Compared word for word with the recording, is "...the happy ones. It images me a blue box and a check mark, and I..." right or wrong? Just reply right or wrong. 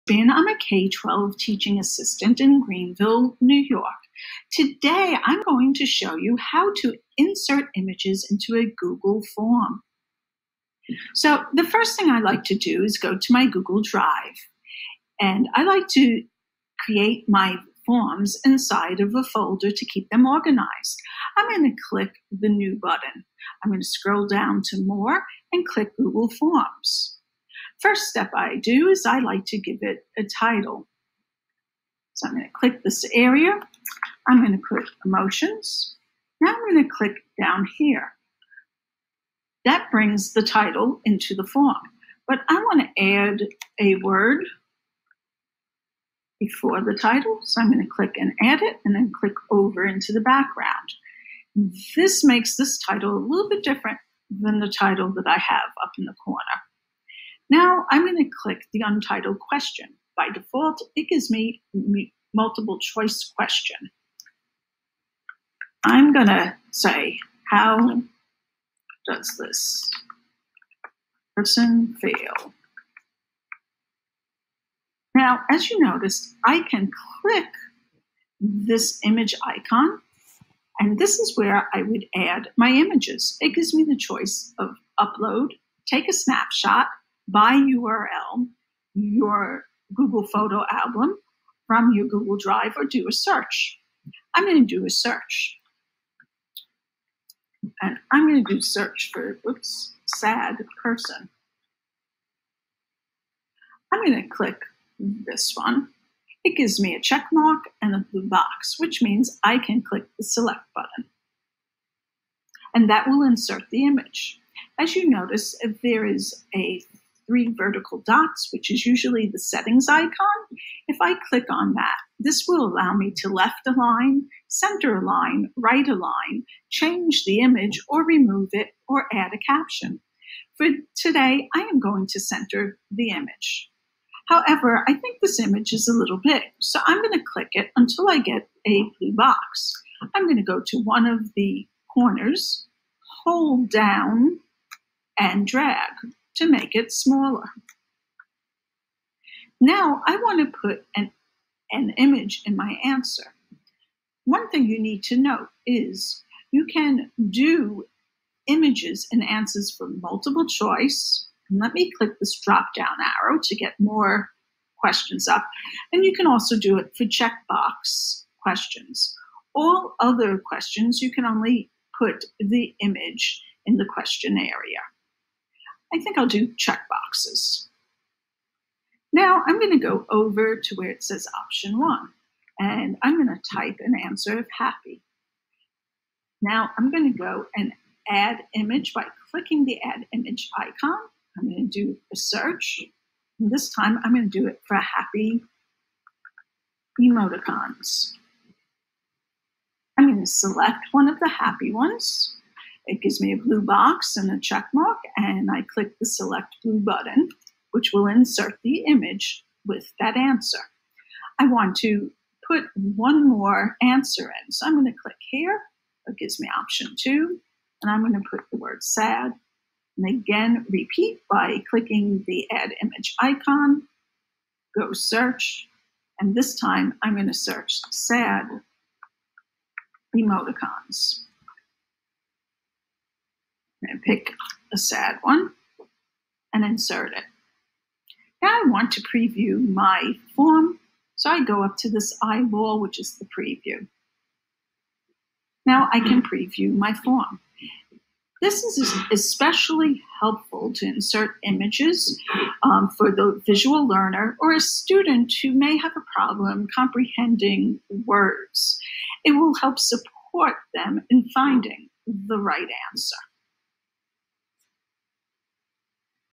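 wrong.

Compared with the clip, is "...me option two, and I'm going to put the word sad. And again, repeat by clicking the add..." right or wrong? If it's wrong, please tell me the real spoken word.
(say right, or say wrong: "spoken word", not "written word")
right.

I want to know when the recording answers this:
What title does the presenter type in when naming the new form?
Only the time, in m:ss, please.
0:35.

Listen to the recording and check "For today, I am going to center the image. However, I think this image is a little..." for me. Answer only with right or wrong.
right.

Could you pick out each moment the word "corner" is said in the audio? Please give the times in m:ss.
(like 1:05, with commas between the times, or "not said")
0:56, 2:21.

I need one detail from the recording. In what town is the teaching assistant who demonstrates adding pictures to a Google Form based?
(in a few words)
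Greenville, New York.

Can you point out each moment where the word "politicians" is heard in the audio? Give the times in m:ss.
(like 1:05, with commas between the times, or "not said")
not said.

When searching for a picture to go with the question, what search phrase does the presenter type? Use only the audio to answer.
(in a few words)
sad person.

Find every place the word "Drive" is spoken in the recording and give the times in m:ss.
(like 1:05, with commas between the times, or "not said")
0:13, 1:32.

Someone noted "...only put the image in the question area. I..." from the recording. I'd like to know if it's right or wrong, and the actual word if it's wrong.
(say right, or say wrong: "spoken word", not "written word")
right.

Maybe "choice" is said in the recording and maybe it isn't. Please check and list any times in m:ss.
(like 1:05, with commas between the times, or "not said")
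1:02, 1:23, 2:40.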